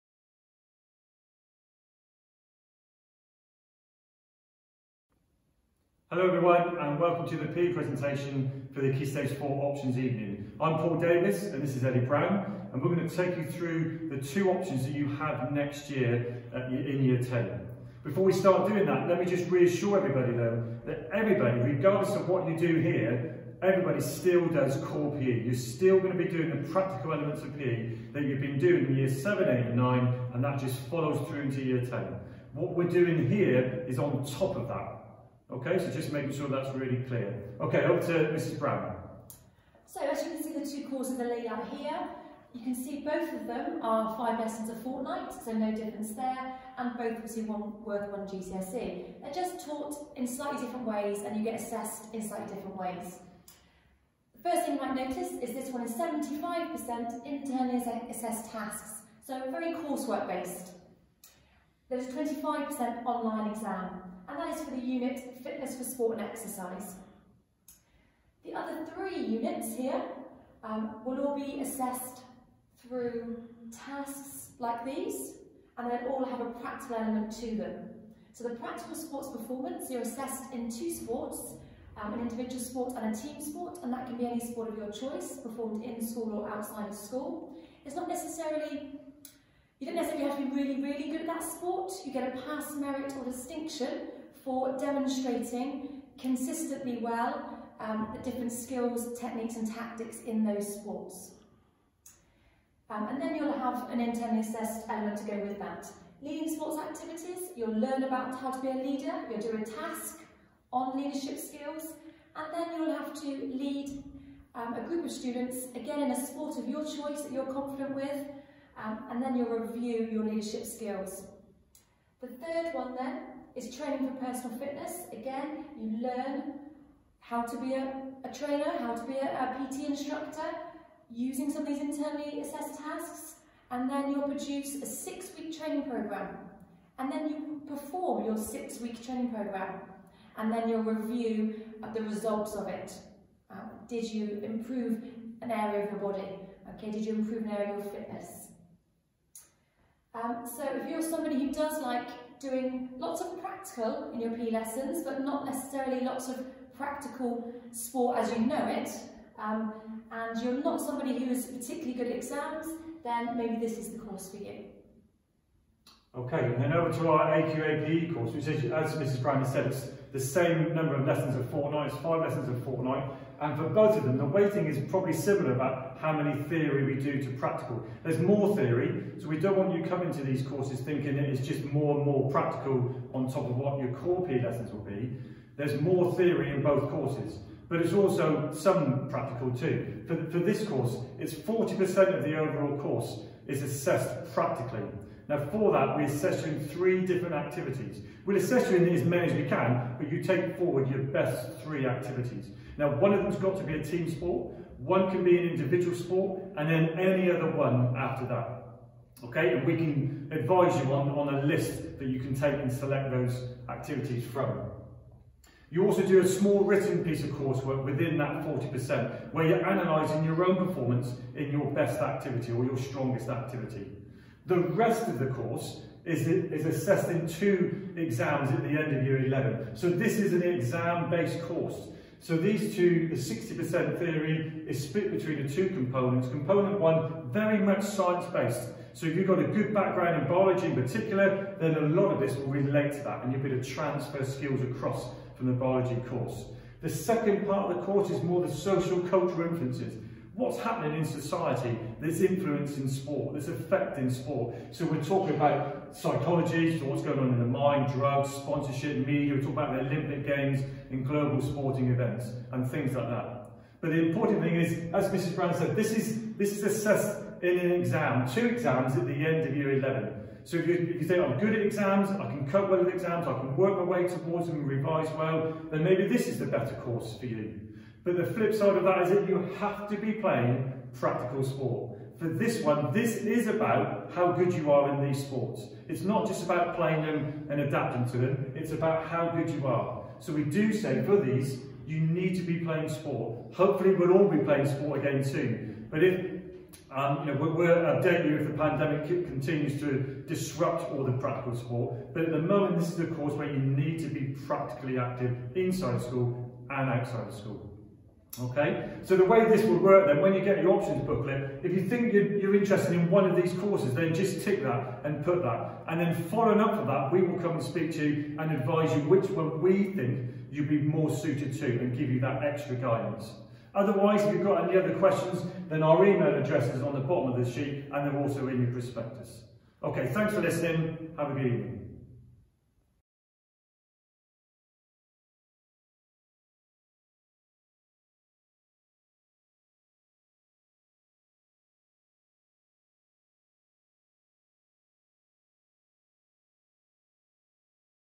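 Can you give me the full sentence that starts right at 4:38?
But the flip side of that is that you have to be playing practical sport.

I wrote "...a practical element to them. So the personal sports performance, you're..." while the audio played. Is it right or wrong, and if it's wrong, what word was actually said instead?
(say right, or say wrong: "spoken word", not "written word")
wrong: "practical", not "personal".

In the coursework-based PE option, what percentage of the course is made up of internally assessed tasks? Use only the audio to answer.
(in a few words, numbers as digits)
75%.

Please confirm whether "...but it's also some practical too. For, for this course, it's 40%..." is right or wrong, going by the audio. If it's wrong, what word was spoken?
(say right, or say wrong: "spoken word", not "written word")
right.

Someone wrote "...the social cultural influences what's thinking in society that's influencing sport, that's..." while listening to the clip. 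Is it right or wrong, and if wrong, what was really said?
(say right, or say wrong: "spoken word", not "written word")
wrong: "happening", not "thinking".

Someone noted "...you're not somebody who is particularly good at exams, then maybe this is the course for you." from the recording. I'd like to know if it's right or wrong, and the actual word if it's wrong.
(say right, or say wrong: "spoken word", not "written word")
right.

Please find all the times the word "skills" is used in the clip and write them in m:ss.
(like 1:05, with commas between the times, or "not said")
1:38, 1:51, 2:00, 4:04.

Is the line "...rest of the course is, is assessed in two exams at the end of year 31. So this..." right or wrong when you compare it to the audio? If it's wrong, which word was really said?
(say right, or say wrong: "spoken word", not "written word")
wrong: "11", not "31".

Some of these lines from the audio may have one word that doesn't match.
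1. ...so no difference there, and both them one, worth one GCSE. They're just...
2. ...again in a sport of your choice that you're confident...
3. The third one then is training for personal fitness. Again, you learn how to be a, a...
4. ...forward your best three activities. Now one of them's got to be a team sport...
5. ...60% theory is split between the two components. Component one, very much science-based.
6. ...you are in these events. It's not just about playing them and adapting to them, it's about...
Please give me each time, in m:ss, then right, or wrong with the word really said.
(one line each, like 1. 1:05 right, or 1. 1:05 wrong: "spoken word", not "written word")
1. 0:45 right
2. 1:55 right
3. 2:02 right
4. 3:20 right
5. 3:53 right
6. 4:44 wrong: "sports", not "events".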